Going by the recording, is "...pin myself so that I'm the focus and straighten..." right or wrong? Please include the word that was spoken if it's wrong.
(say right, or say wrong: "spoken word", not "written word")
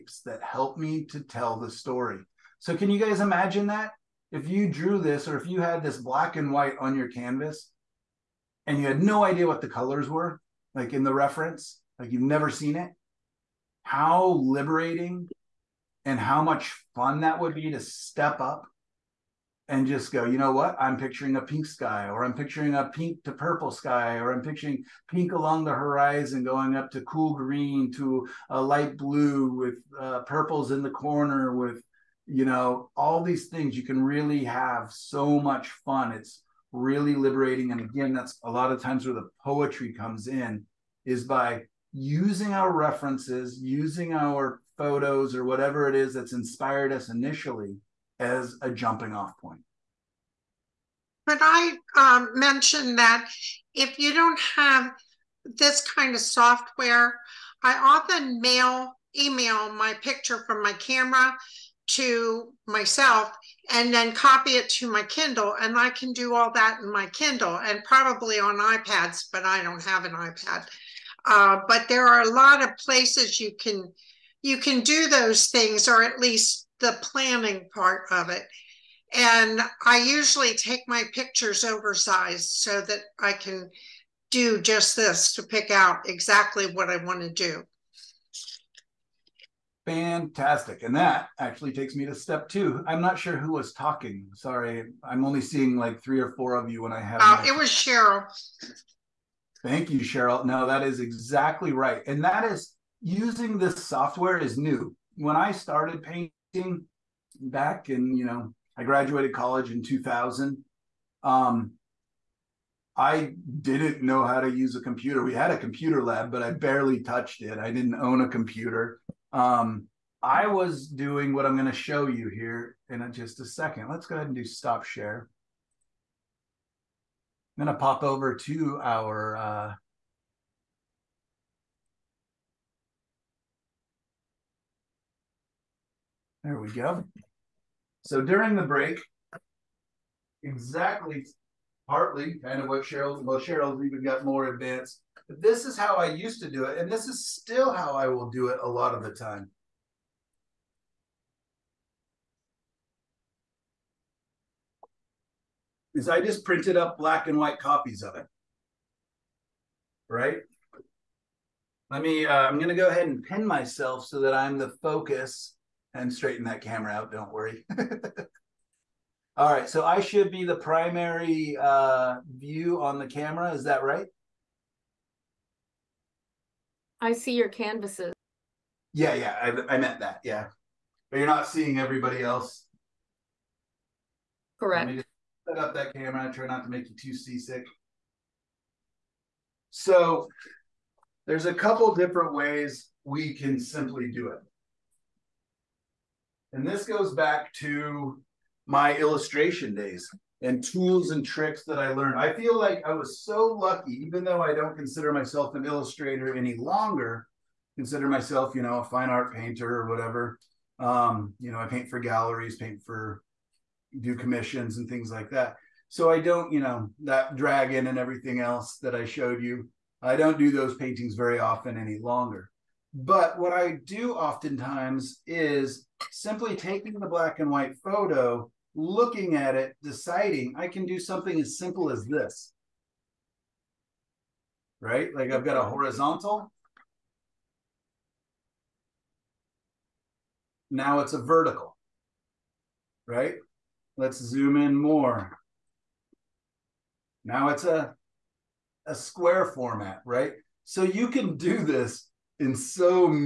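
right.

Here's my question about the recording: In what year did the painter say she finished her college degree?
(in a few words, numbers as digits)
2000.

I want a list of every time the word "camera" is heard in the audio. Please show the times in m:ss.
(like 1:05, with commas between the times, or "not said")
1:00, 2:46, 2:53, 3:05.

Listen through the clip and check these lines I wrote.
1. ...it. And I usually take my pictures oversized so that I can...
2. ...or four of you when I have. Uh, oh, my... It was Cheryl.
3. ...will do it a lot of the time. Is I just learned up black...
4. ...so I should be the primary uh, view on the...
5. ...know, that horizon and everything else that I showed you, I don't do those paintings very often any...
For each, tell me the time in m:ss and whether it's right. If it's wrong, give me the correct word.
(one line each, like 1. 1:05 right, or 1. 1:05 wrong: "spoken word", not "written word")
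1. 1:18 right
2. 1:36 right
3. 2:28 wrong: "printed", not "learned"
4. 2:49 right
5. 3:36 wrong: "dragon", not "horizon".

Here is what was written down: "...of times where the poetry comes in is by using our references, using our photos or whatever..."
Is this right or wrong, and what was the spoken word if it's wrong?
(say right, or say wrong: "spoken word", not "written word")
right.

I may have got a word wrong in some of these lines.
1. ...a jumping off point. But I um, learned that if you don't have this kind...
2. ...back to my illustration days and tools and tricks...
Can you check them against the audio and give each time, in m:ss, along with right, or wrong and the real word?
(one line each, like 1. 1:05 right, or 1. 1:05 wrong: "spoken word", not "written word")
1. 0:48 wrong: "mentioned", not "learned"
2. 3:17 right.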